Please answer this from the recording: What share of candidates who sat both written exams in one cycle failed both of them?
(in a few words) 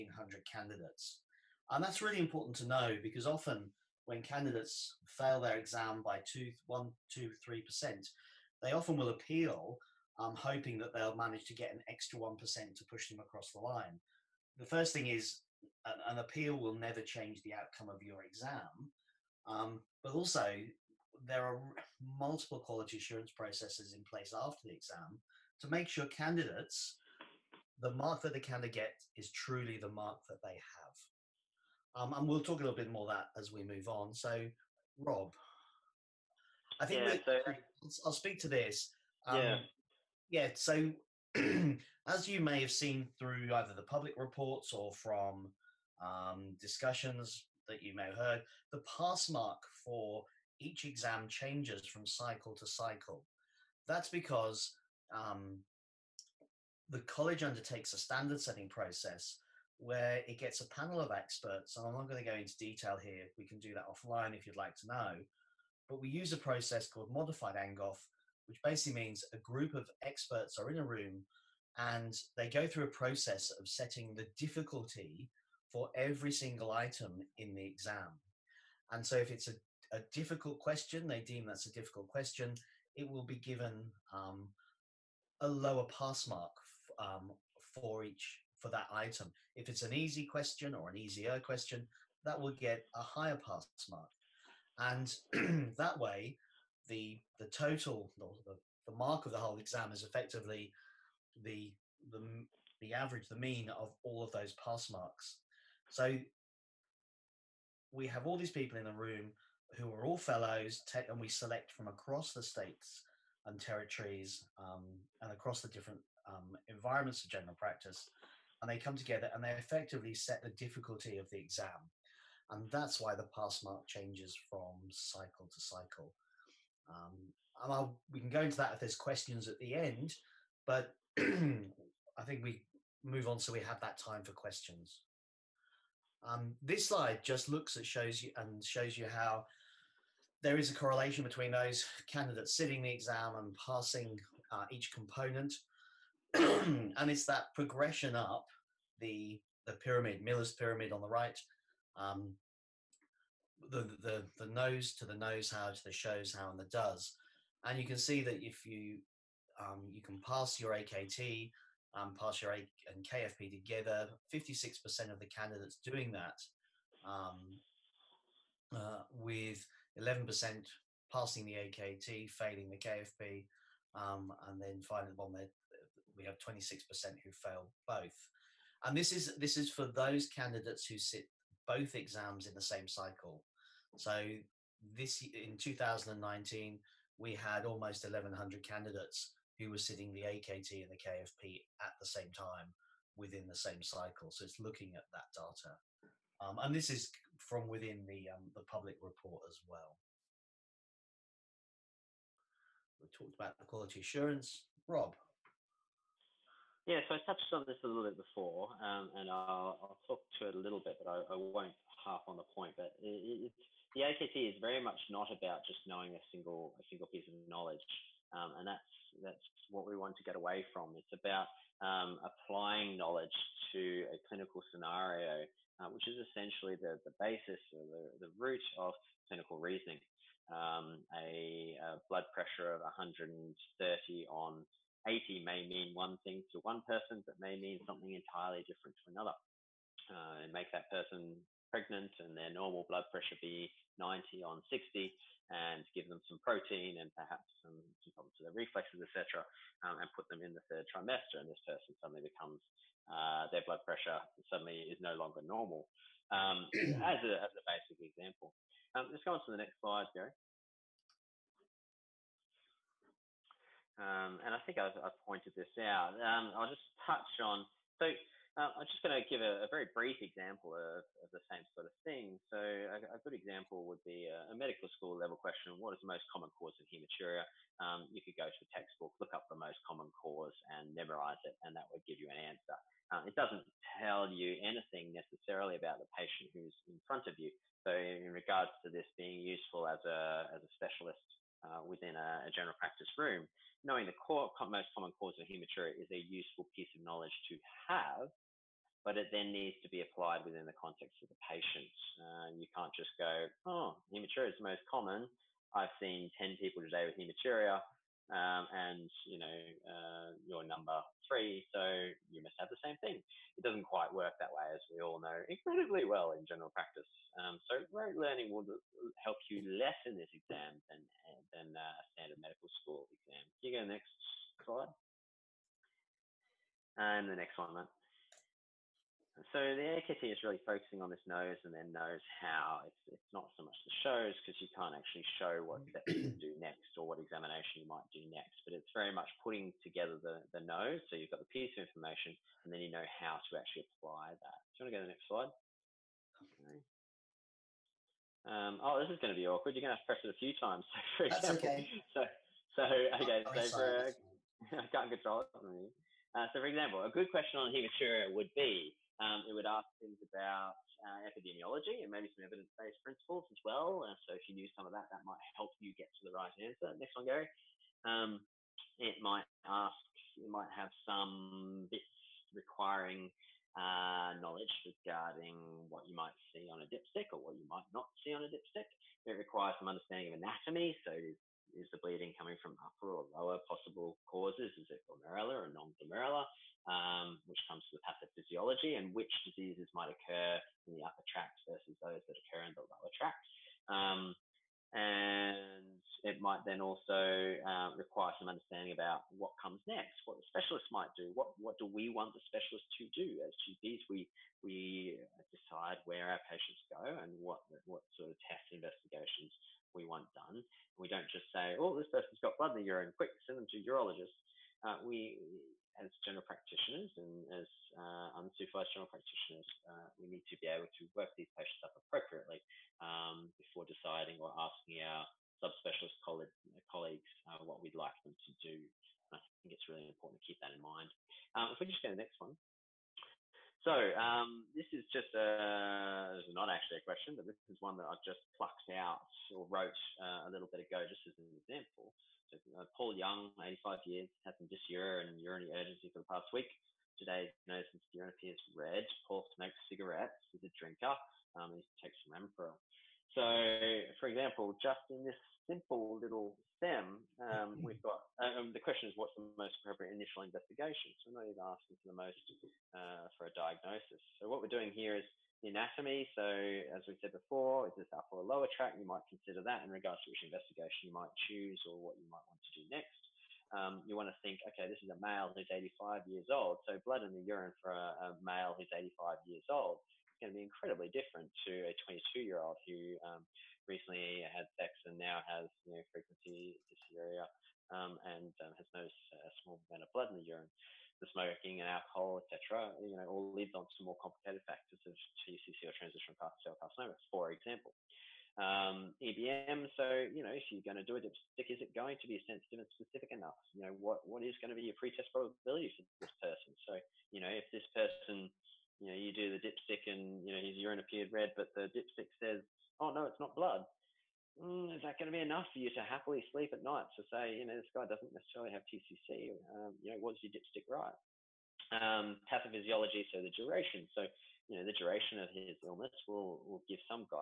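26%.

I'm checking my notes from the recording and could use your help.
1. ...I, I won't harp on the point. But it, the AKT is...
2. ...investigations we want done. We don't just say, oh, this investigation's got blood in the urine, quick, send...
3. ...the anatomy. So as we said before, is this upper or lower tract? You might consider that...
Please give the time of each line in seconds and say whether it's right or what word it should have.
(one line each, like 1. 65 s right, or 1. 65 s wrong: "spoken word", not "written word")
1. 211 s right
2. 408 s wrong: "person", not "investigation"
3. 465 s right.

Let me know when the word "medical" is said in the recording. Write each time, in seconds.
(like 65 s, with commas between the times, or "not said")
274 s, 322 s.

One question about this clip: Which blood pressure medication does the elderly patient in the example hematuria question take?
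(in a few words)
ramipril.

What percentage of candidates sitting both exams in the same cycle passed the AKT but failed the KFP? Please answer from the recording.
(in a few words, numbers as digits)
11%.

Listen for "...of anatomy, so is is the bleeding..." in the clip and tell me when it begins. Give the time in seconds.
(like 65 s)
380 s.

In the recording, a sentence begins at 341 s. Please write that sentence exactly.
So you've got the piece of information and then you know how to actually apply that.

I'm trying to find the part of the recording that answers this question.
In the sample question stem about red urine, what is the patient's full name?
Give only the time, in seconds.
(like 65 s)
442 s.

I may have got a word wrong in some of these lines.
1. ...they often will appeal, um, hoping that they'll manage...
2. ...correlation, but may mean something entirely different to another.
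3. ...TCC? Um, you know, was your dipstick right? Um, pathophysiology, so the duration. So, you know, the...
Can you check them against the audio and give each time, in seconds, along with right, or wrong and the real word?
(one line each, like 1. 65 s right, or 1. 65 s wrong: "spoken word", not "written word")
1. 8 s right
2. 236 s wrong: "person", not "correlation"
3. 518 s right.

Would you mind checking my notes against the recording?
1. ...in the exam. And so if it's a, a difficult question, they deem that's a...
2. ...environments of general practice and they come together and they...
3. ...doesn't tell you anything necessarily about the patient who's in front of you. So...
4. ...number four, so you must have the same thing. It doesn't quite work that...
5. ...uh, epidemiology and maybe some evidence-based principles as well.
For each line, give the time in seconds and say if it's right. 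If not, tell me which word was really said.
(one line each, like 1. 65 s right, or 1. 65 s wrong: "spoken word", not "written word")
1. 77 s right
2. 116 s right
3. 283 s right
4. 310 s wrong: "three", not "four"
5. 361 s right.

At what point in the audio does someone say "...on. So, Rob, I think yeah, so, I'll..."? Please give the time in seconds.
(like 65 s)
33 s.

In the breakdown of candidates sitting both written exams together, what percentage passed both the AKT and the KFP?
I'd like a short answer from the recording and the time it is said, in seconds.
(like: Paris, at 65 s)
56%, at 164 s.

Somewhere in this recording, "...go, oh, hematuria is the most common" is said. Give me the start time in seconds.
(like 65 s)
303 s.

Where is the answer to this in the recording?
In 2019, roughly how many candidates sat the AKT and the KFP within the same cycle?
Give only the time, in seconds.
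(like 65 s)
188 s.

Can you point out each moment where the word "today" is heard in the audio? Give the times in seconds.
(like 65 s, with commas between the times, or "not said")
306 s, 447 s.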